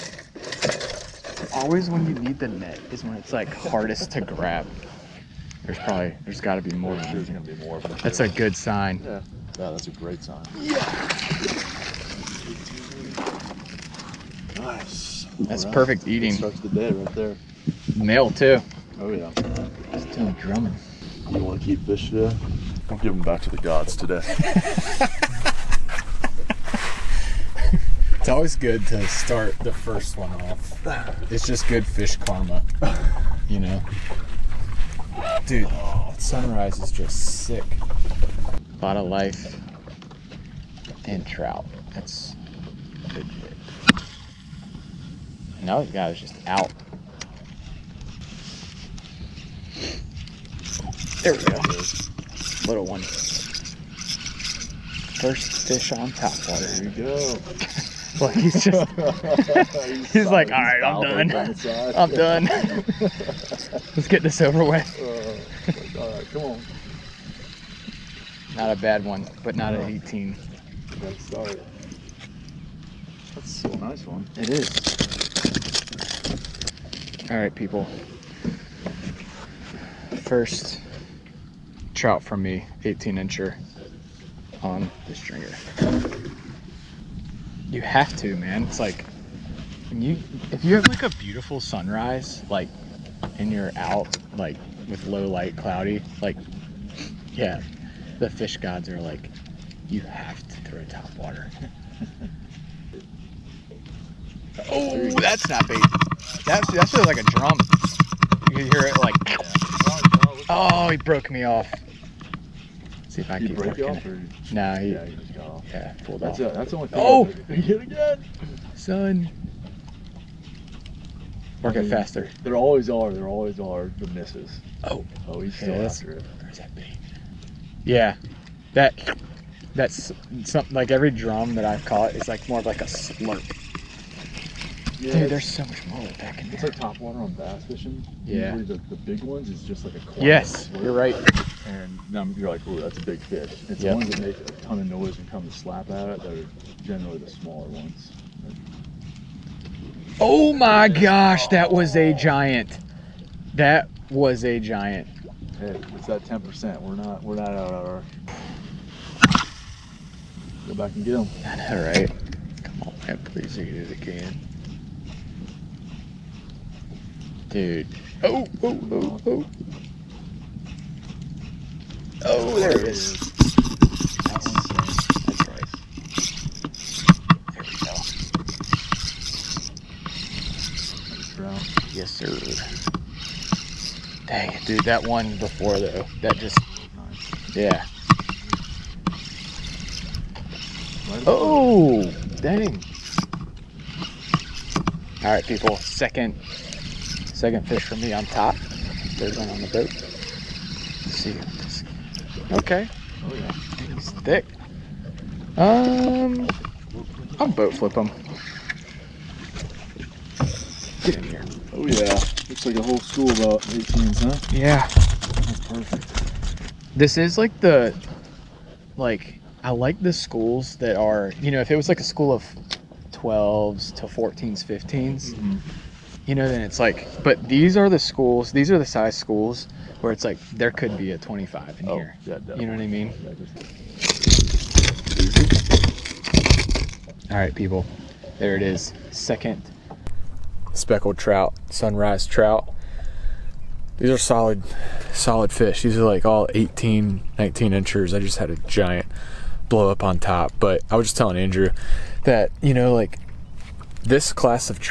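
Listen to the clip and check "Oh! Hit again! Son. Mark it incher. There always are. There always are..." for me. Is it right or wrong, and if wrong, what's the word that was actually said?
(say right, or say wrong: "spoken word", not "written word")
wrong: "faster", not "incher".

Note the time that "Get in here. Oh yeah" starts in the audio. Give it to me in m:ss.
3:31.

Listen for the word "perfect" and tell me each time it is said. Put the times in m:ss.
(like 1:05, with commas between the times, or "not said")
0:15, 3:35.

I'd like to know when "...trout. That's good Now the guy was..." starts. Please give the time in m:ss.
0:41.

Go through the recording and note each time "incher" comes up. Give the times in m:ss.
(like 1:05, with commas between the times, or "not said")
1:23, 4:07.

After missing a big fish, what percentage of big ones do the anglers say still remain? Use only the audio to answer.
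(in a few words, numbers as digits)
10%.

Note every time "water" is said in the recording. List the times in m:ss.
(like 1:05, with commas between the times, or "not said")
0:56, 1:41, 2:16.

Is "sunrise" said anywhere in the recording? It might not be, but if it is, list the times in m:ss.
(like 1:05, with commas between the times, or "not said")
0:36, 1:31, 4:01.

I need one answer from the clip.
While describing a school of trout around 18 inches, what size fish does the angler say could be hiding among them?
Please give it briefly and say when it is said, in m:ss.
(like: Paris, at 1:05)
25 inches, at 3:51.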